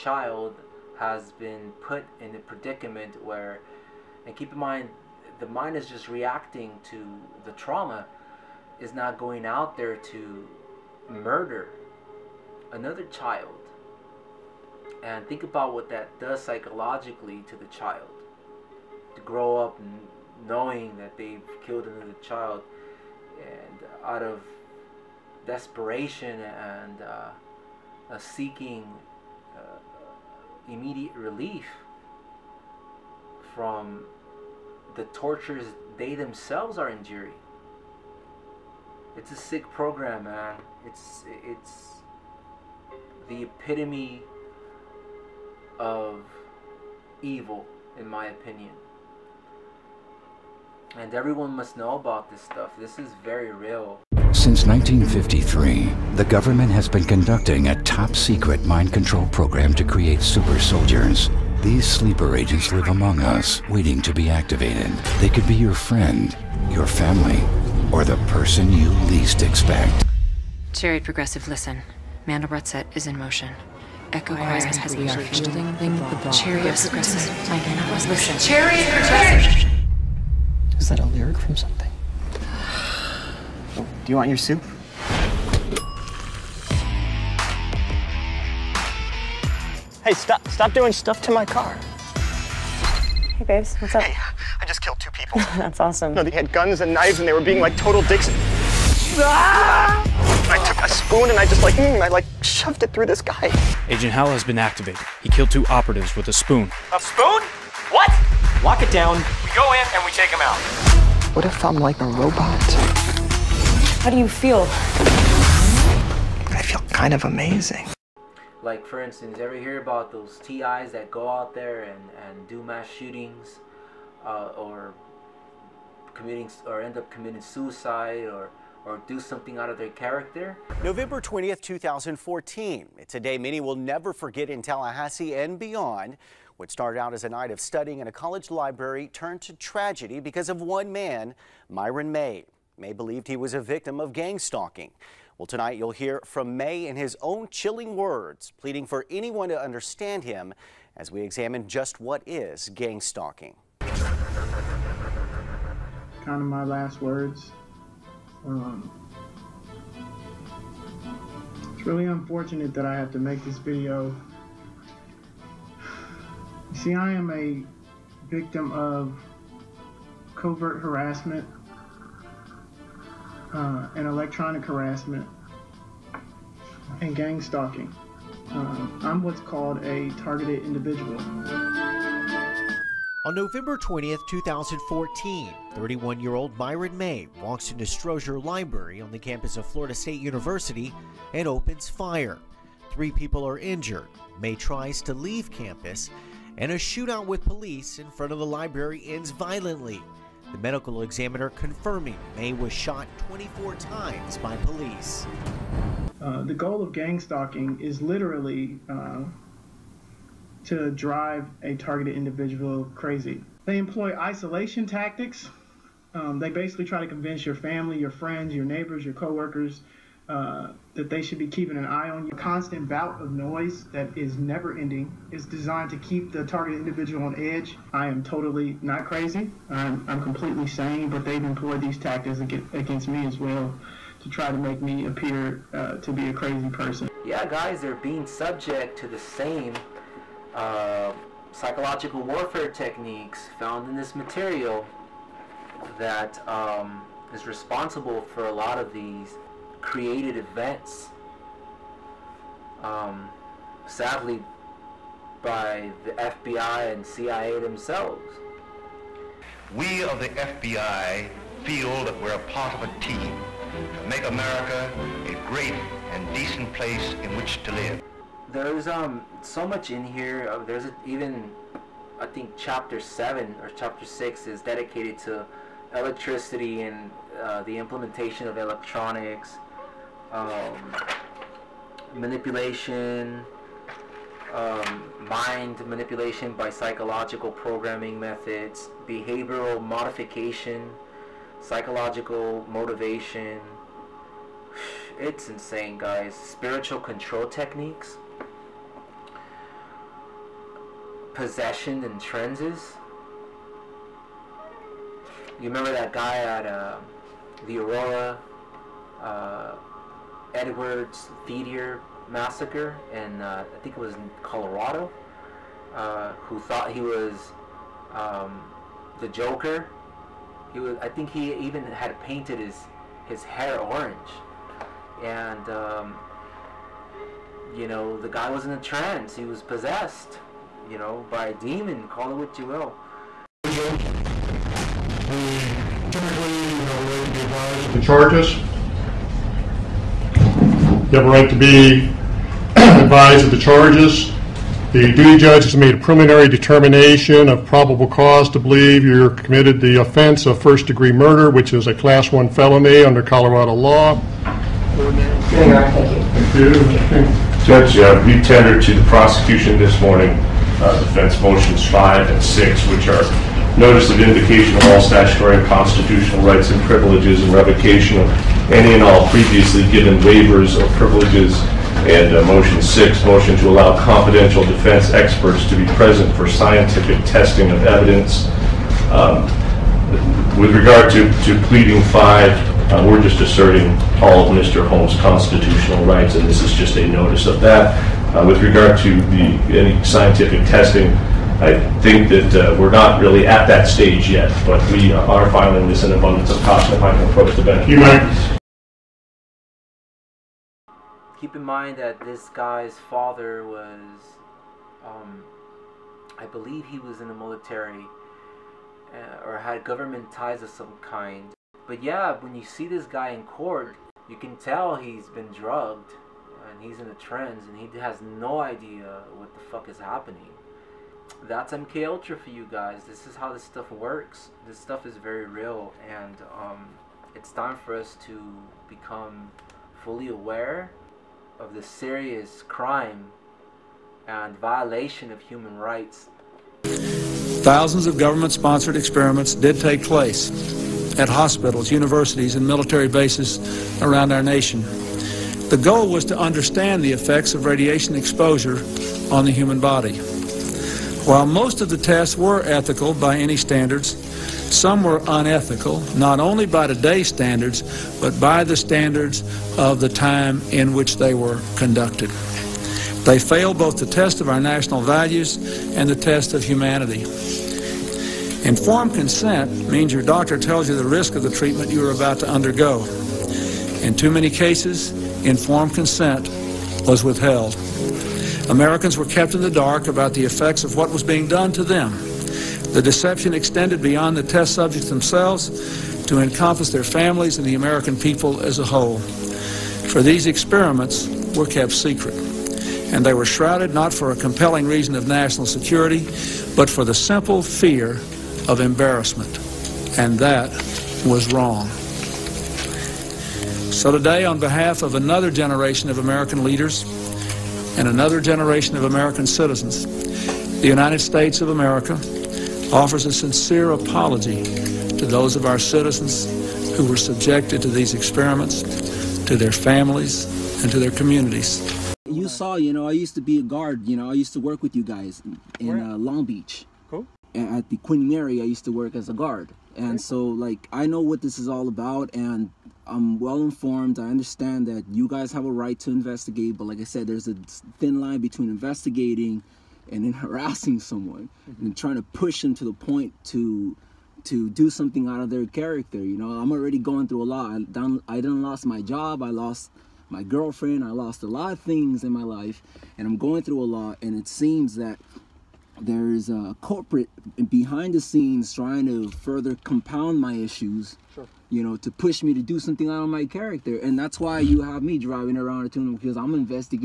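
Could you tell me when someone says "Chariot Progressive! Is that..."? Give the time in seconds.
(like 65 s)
78 s.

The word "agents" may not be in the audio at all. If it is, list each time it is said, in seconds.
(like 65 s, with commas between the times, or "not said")
62 s, 103 s.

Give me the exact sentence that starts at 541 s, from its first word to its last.
and trying to push them to the point to to do something out of their character.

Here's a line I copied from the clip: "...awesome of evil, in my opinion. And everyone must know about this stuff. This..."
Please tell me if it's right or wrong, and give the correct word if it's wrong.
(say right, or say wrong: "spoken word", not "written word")
wrong: "epitome", not "awesome".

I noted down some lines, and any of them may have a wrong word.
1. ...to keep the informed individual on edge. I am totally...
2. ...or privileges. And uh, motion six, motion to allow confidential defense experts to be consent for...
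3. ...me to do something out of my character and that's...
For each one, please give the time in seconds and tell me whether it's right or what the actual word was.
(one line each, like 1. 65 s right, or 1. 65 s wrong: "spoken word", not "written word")
1. 225 s wrong: "targeted", not "informed"
2. 370 s wrong: "present", not "consent"
3. 562 s right.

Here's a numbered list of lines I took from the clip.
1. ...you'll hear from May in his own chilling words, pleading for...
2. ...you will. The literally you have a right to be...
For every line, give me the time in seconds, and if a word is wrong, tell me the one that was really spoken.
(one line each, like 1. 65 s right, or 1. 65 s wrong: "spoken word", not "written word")
1. 145 s right
2. 332 s wrong: "typically", not "literally".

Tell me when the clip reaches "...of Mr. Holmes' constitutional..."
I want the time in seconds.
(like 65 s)
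384 s.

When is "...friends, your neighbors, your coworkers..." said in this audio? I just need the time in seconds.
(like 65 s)
218 s.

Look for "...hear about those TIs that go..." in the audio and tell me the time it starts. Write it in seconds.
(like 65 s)
119 s.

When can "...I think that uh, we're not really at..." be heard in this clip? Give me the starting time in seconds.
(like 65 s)
391 s.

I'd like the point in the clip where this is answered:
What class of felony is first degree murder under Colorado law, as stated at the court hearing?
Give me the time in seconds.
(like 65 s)
351 s.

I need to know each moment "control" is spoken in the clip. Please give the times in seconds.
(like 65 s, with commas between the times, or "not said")
58 s, 296 s.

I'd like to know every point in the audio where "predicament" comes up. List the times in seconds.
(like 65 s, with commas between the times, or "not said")
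2 s.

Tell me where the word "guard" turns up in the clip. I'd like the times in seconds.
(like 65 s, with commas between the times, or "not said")
523 s, 529 s.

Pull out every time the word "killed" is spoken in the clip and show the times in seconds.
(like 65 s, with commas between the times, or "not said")
21 s, 94 s, 105 s.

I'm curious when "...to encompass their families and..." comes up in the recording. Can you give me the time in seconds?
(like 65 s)
486 s.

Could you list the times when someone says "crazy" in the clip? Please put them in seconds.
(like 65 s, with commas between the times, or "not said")
212 s, 229 s, 236 s.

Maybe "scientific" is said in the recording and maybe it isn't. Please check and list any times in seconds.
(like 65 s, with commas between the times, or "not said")
376 s, 390 s.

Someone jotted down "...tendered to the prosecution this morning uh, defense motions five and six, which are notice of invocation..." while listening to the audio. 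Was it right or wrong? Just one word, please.
right.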